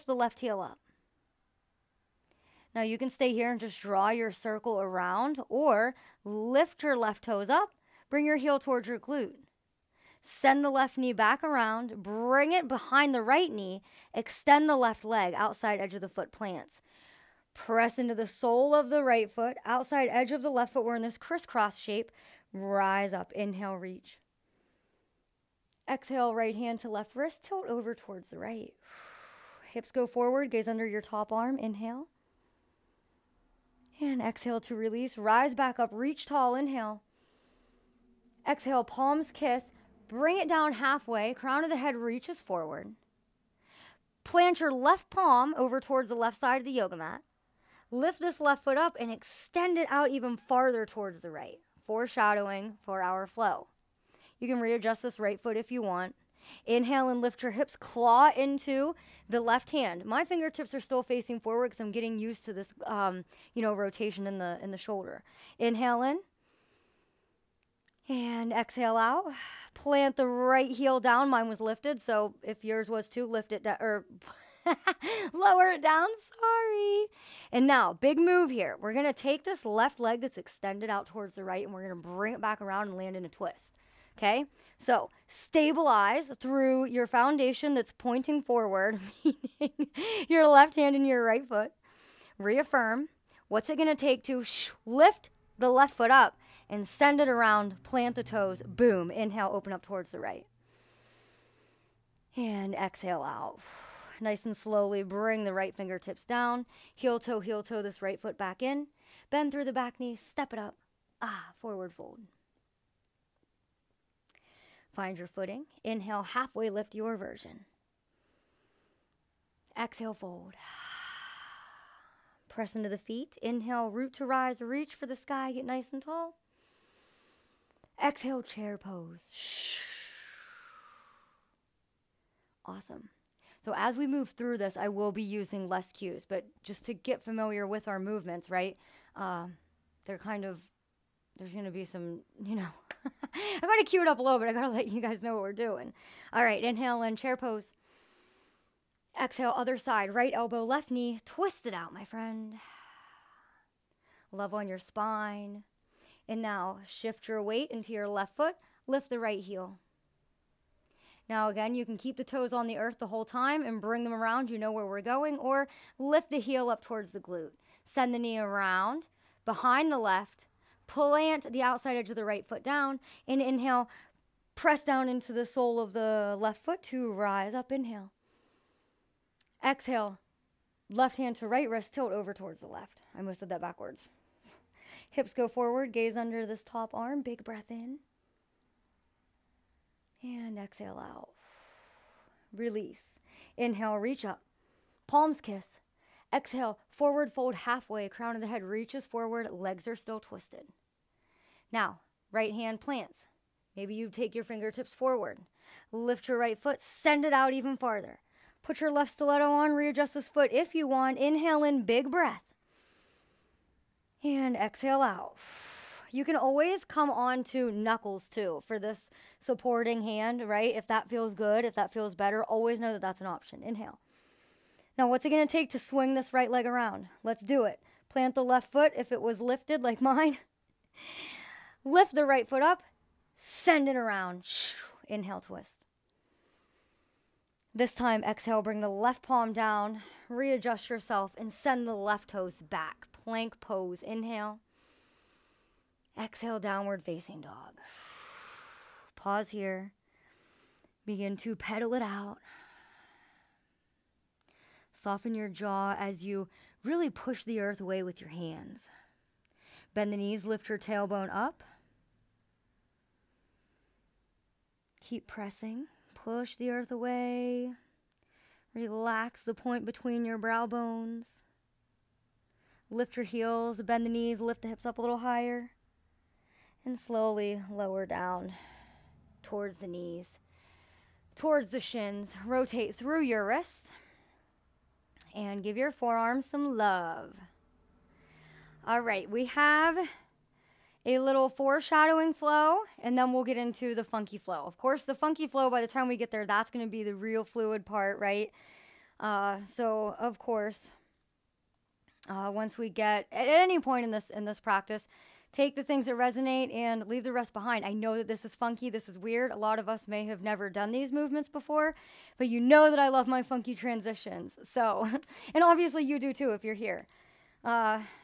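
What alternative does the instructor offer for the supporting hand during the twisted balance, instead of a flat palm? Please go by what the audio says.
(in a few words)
knuckles.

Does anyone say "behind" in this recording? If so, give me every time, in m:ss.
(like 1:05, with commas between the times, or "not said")
0:12, 2:49, 5:07.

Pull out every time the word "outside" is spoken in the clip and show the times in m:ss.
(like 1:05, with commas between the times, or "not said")
0:15, 0:19, 2:51.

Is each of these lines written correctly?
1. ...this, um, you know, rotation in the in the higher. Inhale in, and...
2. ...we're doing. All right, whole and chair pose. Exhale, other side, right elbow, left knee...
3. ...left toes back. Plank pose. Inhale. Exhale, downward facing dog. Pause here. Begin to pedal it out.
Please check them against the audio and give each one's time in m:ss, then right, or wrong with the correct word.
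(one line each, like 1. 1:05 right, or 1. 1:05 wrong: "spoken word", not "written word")
1. 1:02 wrong: "shoulder", not "higher"
2. 2:25 wrong: "inhale", not "whole"
3. 4:01 right.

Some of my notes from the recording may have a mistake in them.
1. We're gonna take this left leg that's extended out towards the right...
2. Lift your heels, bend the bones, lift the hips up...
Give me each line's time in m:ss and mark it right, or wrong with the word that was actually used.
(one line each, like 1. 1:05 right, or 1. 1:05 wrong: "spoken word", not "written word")
1. 1:18 right
2. 4:32 wrong: "knees", not "bones".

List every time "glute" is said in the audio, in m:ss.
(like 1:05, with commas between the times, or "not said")
0:08, 2:47.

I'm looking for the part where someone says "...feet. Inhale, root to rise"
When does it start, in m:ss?
2:02.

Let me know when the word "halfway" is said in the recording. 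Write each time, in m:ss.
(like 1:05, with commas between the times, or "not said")
0:40, 1:56, 3:17.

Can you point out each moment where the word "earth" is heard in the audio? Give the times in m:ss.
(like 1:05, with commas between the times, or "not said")
2:42, 4:17, 4:26.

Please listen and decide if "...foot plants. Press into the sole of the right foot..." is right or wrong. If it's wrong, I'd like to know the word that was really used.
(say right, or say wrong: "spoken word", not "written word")
right.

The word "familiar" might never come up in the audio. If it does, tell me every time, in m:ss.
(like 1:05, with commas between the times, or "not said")
2:17.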